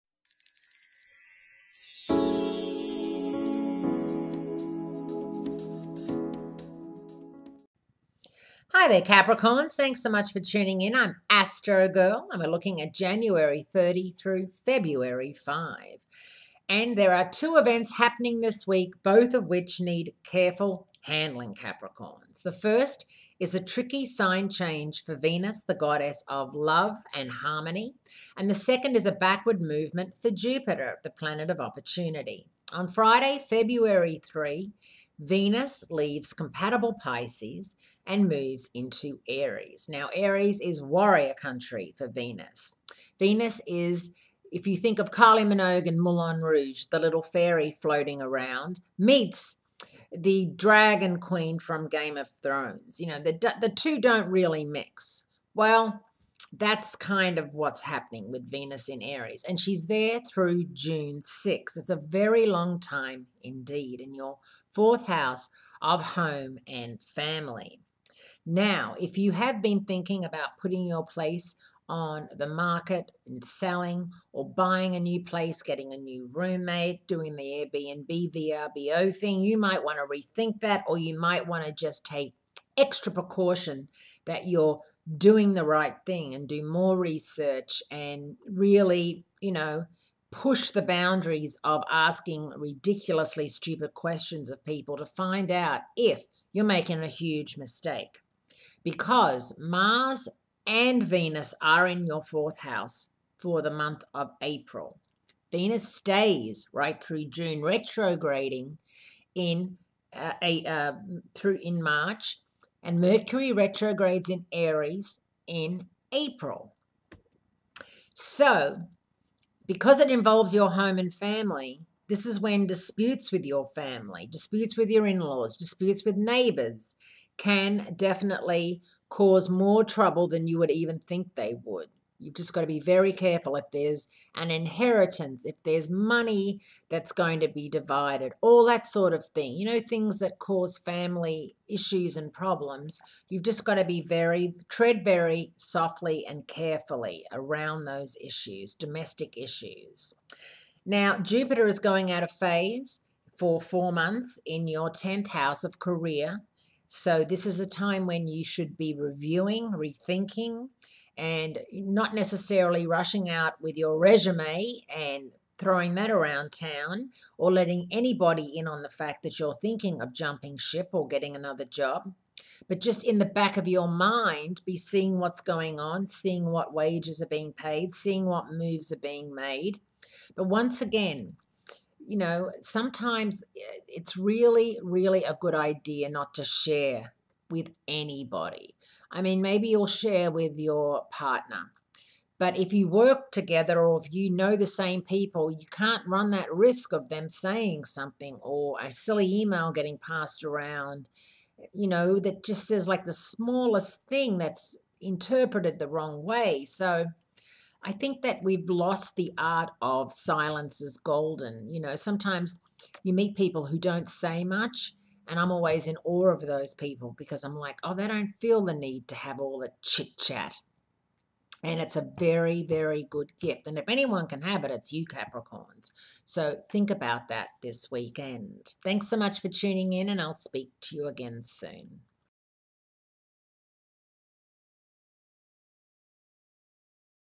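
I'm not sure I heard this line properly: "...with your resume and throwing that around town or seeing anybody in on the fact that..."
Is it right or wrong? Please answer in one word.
wrong.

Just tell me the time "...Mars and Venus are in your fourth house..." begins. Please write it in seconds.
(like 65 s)
99 s.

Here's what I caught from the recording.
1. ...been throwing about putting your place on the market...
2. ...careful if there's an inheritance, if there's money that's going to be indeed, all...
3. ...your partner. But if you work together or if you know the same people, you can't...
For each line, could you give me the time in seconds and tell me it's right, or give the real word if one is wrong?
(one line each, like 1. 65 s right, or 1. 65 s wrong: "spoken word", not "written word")
1. 69 s wrong: "thinking", not "throwing"
2. 133 s wrong: "divided", not "indeed"
3. 190 s right.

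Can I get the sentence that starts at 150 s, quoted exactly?
Now, Jupiter is going out of phase for four months in your 10th house of career.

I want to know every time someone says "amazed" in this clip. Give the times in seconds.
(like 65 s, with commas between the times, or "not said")
not said.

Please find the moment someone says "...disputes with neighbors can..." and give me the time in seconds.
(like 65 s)
125 s.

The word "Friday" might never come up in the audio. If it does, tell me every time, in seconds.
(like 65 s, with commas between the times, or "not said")
32 s.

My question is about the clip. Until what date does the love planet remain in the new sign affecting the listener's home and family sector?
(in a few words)
June 6.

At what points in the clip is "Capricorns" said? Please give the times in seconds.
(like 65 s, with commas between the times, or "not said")
9 s, 21 s, 225 s.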